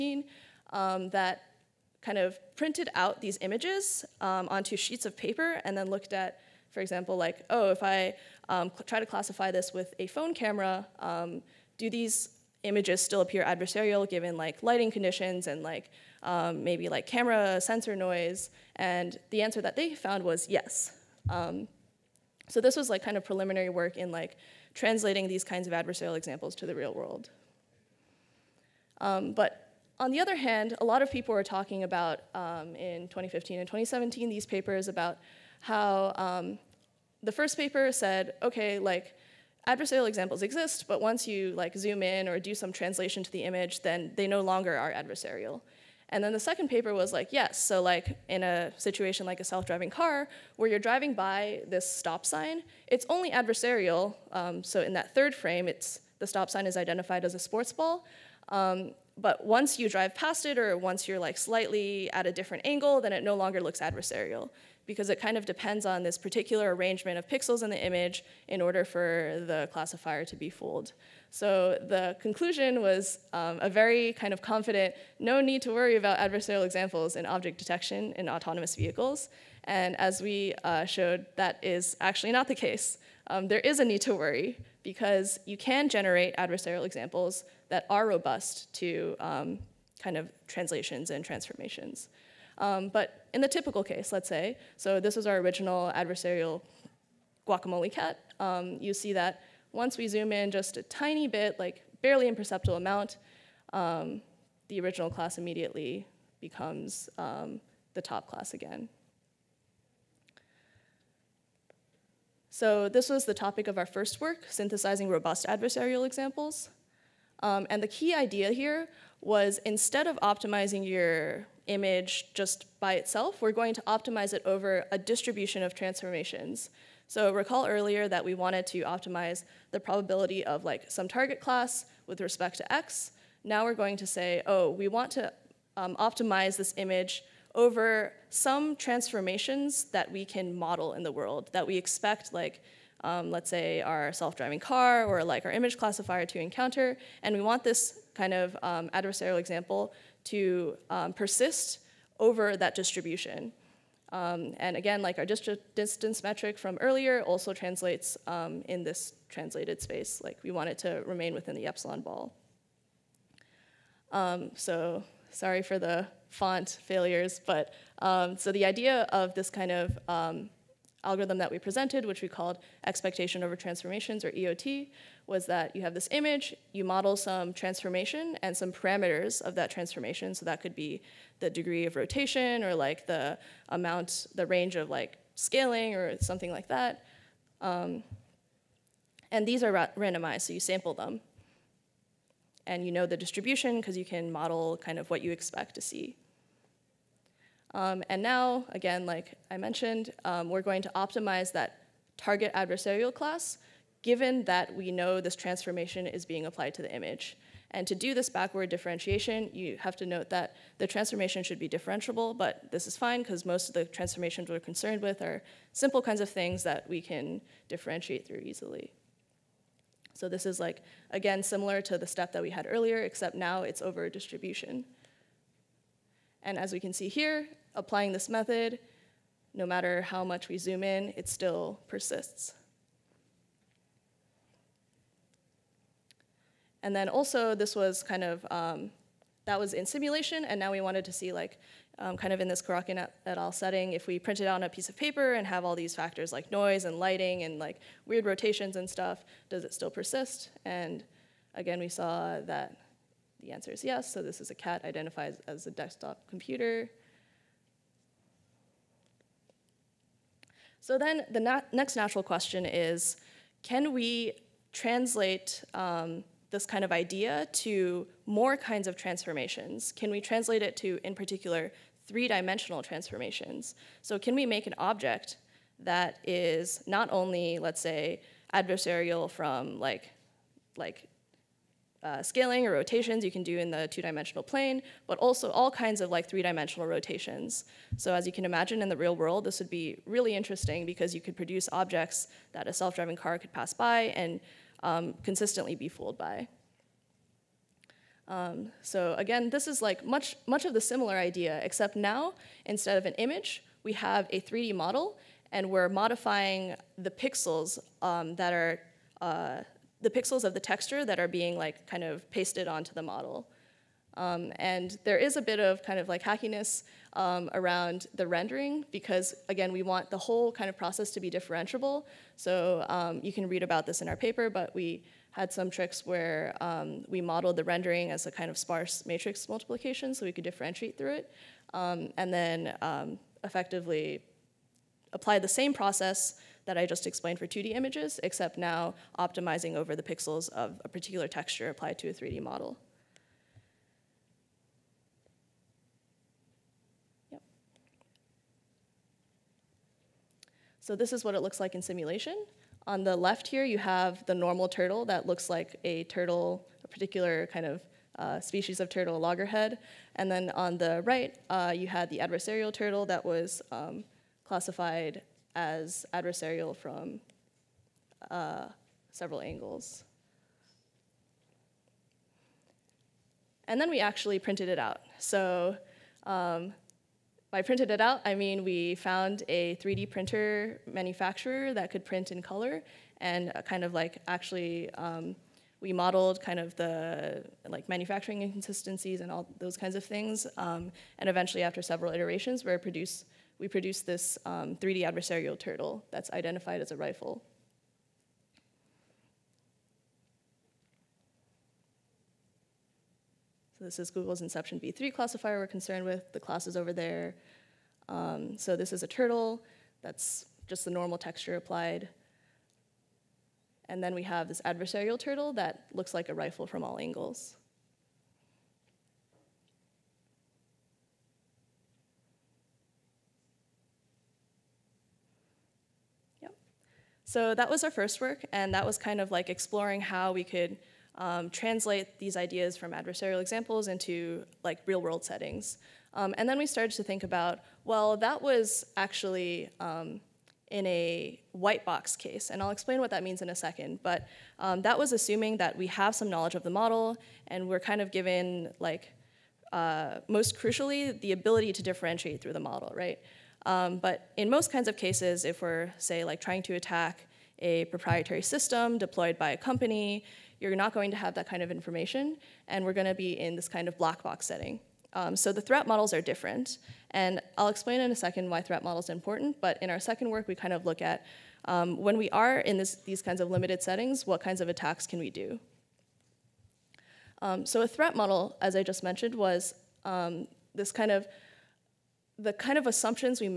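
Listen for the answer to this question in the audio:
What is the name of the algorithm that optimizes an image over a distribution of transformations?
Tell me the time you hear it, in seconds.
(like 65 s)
172 s.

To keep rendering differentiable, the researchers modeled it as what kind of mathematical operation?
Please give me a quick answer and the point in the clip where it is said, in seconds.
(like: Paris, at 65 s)
Sparse matrix multiplication, at 328 s.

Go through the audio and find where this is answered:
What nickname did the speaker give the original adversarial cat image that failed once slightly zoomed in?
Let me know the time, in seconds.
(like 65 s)
97 s.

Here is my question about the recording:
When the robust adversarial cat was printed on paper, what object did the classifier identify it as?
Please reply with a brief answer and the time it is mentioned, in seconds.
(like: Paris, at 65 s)
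Desktop computer, at 255 s.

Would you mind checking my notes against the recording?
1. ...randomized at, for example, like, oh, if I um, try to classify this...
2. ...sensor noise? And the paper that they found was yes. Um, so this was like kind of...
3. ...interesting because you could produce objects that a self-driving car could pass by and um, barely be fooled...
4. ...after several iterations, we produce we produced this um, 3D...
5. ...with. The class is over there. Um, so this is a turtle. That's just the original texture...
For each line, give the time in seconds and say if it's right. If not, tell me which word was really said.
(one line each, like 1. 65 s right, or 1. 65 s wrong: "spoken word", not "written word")
1. 5 s wrong: "looked", not "randomized"
2. 17 s wrong: "answer", not "paper"
3. 290 s wrong: "consistently", not "barely"
4. 391 s right
5. 406 s wrong: "normal", not "original".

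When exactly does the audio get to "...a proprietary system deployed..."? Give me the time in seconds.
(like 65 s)
457 s.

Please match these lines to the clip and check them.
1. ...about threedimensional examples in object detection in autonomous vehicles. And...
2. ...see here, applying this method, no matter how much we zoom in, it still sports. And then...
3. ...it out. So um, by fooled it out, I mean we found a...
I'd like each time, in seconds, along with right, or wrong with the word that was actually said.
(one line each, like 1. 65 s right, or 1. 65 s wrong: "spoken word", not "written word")
1. 75 s wrong: "adversarial", not "threedimensional"
2. 226 s wrong: "persists", not "sports"
3. 374 s wrong: "printed", not "fooled".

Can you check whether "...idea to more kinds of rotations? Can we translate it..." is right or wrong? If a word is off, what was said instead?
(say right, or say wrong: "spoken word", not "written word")
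wrong: "transformations", not "rotations".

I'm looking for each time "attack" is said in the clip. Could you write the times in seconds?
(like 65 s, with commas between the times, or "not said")
456 s, 474 s.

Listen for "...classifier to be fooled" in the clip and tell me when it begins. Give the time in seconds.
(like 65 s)
69 s.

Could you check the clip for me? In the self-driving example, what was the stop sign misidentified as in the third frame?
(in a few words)
Sports ball.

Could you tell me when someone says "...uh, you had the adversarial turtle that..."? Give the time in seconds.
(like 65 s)
361 s.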